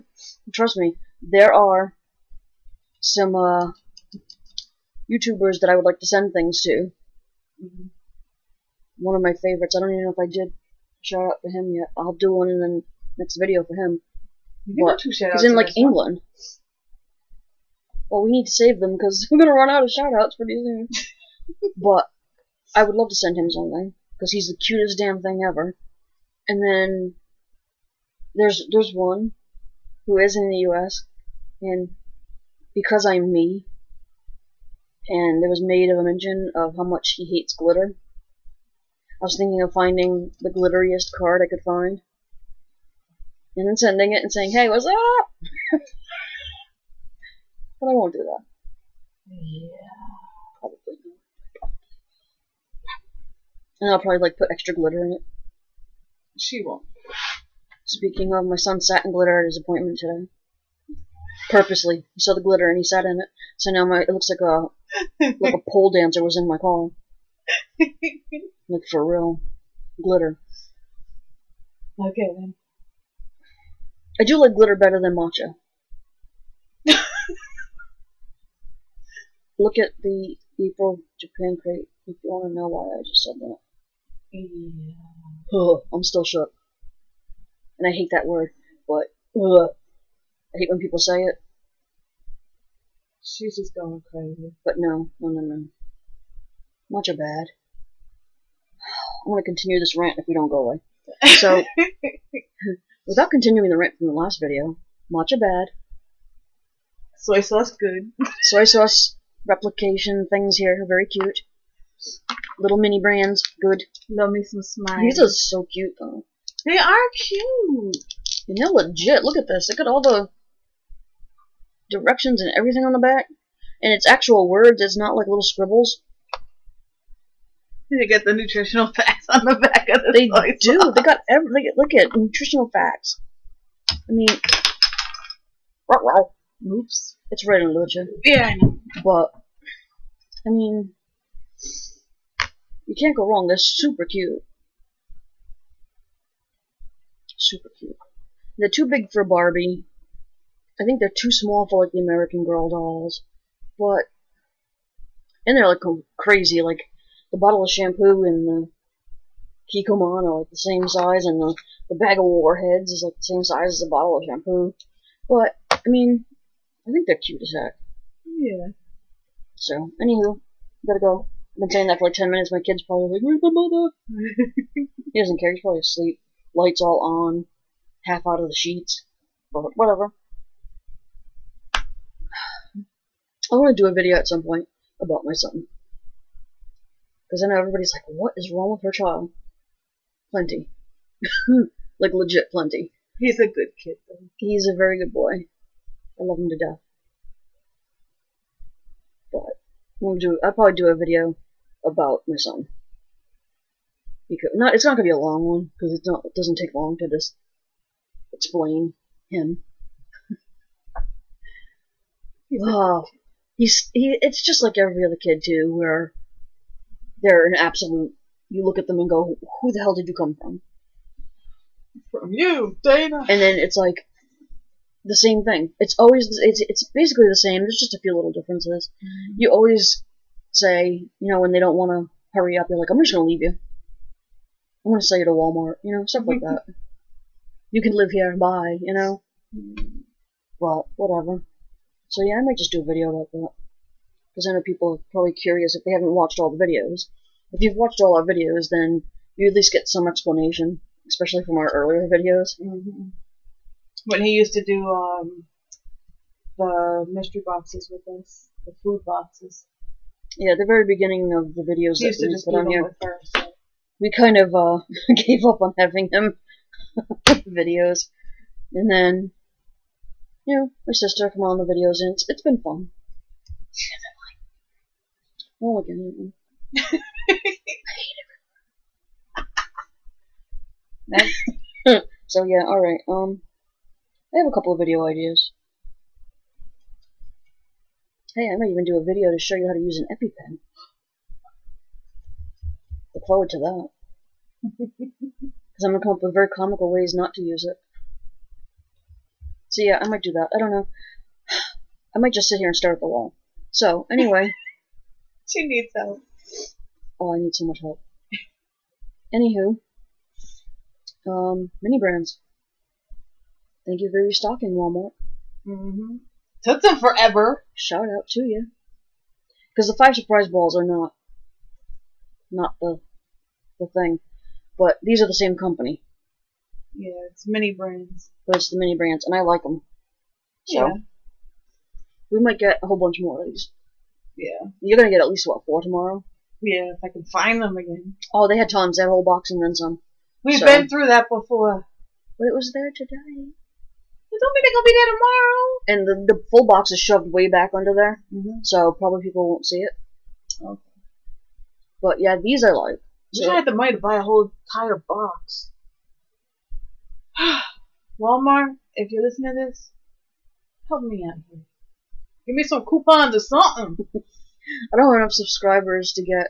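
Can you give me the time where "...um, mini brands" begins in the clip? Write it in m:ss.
5:11.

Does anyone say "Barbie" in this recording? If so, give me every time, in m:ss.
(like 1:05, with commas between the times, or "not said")
2:29.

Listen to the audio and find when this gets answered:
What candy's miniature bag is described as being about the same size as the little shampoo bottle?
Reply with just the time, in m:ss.
2:42.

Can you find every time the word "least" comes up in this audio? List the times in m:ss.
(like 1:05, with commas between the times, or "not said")
4:09, 5:35.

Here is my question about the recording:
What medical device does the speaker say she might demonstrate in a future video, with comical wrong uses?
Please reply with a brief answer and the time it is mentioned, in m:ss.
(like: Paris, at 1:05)
EpiPen, at 4:50.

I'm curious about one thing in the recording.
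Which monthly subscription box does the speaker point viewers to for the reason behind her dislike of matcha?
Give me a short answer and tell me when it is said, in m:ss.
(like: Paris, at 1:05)
April Japan crate, at 1:20.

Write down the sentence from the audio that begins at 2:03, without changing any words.
And it's actual words, it's not like little scribbles.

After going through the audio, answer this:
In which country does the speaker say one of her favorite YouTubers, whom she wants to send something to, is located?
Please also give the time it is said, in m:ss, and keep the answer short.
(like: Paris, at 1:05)
England, at 0:15.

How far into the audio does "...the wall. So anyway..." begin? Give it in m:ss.
5:03.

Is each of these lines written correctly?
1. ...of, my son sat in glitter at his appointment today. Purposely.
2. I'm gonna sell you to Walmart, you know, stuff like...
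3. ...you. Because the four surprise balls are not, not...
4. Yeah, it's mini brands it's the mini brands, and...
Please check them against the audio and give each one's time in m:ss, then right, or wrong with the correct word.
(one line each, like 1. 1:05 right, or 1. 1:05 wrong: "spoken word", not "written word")
1. 0:58 right
2. 3:54 right
3. 5:18 wrong: "five", not "four"
4. 5:26 right.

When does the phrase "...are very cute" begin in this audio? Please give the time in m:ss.
1:50.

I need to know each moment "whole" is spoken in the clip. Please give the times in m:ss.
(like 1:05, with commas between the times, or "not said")
5:32, 5:39, 5:54.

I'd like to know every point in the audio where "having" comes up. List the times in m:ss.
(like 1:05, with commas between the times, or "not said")
4:25.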